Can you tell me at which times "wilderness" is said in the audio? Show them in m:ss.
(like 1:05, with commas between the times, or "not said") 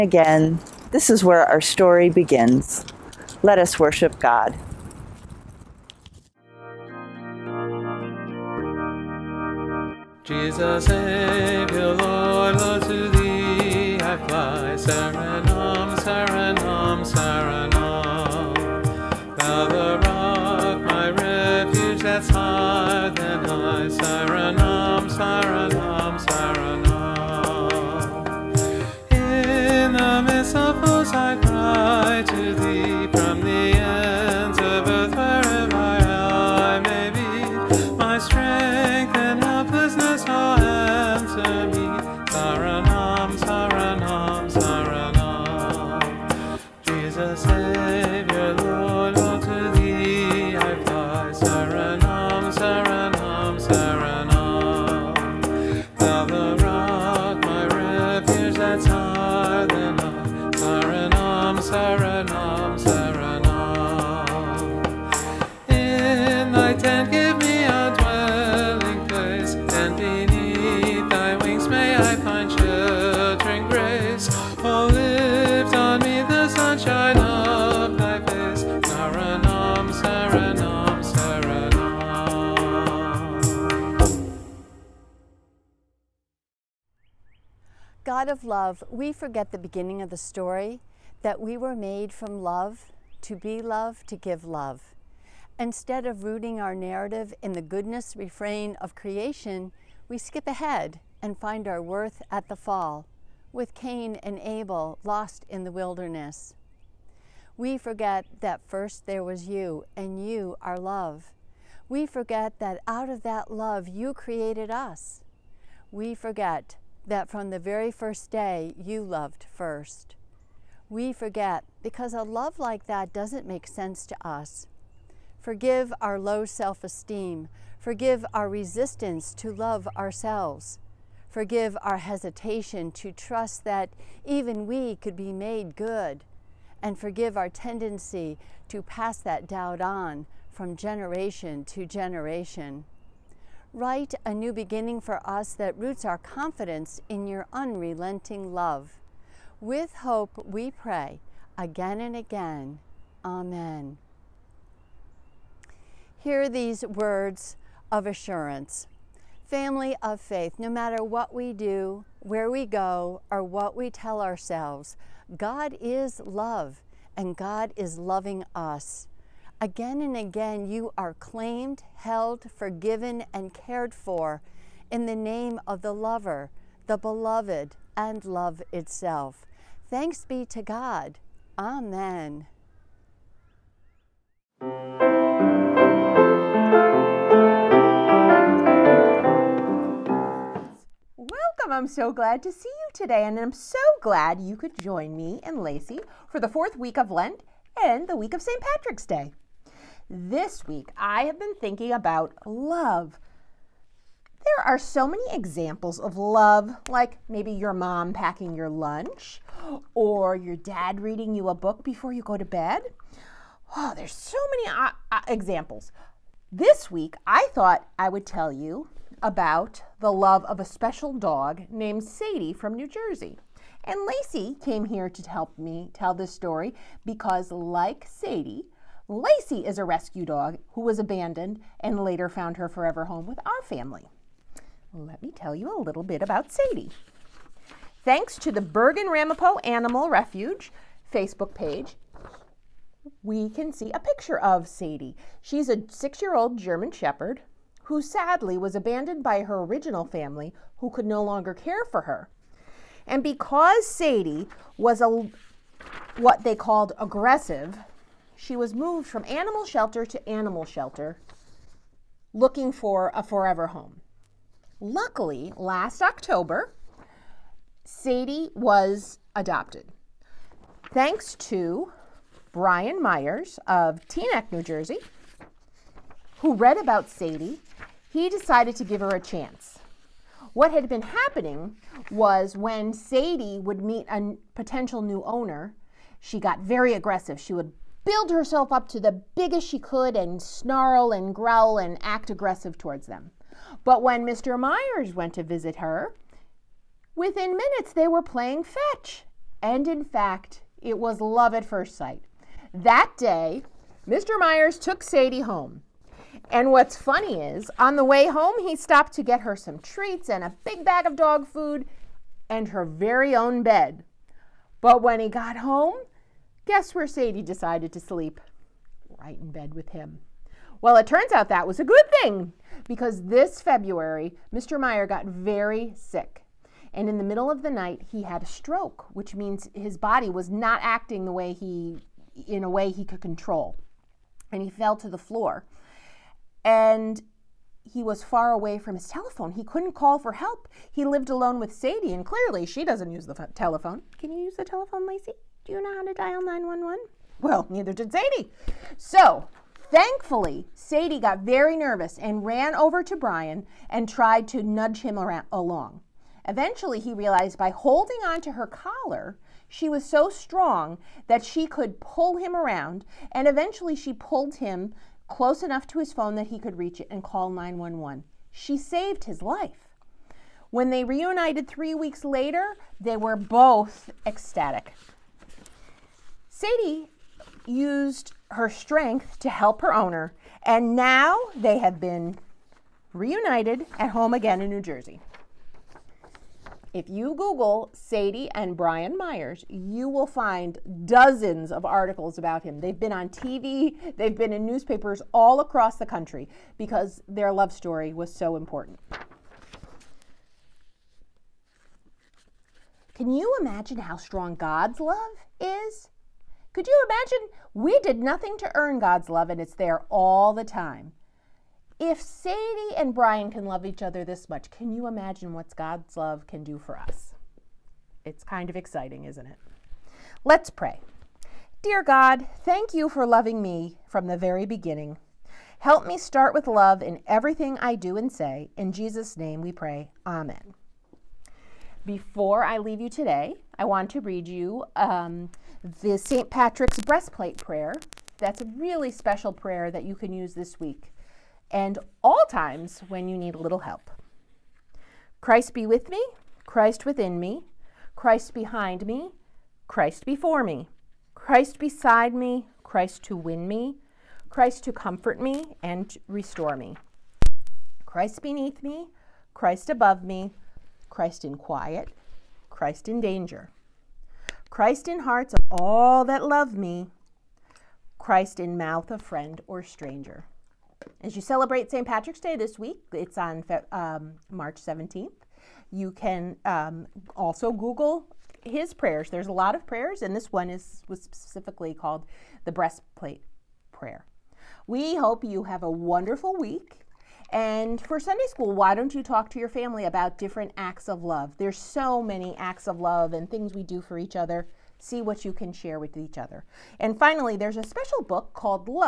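1:45.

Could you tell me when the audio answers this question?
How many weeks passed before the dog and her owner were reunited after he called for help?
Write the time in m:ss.
6:11.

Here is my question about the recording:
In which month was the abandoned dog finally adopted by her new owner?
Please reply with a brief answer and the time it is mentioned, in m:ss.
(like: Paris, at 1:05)
October, at 4:26.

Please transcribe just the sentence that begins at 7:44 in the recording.
Christ in hearts of all that love me, Christ in mouth of friend or stranger.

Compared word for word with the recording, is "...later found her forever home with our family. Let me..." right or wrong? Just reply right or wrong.
right.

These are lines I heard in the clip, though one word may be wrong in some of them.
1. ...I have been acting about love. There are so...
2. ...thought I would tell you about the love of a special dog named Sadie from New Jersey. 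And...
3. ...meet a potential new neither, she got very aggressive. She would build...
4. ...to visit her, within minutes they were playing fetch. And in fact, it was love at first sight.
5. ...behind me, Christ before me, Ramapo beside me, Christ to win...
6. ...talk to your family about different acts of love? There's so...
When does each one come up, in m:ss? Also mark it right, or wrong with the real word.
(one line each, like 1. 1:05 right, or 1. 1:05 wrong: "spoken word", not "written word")
1. 3:20 wrong: "thinking", not "acting"
2. 3:37 right
3. 4:43 wrong: "owner", not "neither"
4. 4:55 right
5. 7:28 wrong: "Christ", not "Ramapo"
6. 8:09 right.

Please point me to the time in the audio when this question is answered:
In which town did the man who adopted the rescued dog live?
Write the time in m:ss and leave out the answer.
4:34.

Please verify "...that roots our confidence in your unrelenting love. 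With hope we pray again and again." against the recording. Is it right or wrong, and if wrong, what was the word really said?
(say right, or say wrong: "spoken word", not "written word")
right.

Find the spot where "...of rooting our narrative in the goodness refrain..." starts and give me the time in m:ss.
1:36.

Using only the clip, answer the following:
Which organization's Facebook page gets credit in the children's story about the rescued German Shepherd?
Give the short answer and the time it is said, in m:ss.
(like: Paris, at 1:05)
Bergen Ramapo Animal Refuge, at 3:58.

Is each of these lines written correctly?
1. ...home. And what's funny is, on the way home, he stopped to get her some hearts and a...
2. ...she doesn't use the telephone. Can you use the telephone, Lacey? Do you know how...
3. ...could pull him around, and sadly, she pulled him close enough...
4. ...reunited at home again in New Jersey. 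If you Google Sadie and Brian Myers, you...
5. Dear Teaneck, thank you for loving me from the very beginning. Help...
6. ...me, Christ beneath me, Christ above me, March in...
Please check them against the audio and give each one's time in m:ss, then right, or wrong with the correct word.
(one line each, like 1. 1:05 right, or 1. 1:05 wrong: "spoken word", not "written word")
1. 5:05 wrong: "treats", not "hearts"
2. 5:42 right
3. 6:01 wrong: "eventually", not "sadly"
4. 6:23 right
5. 7:01 wrong: "God", not "Teaneck"
6. 7:36 wrong: "Christ", not "March".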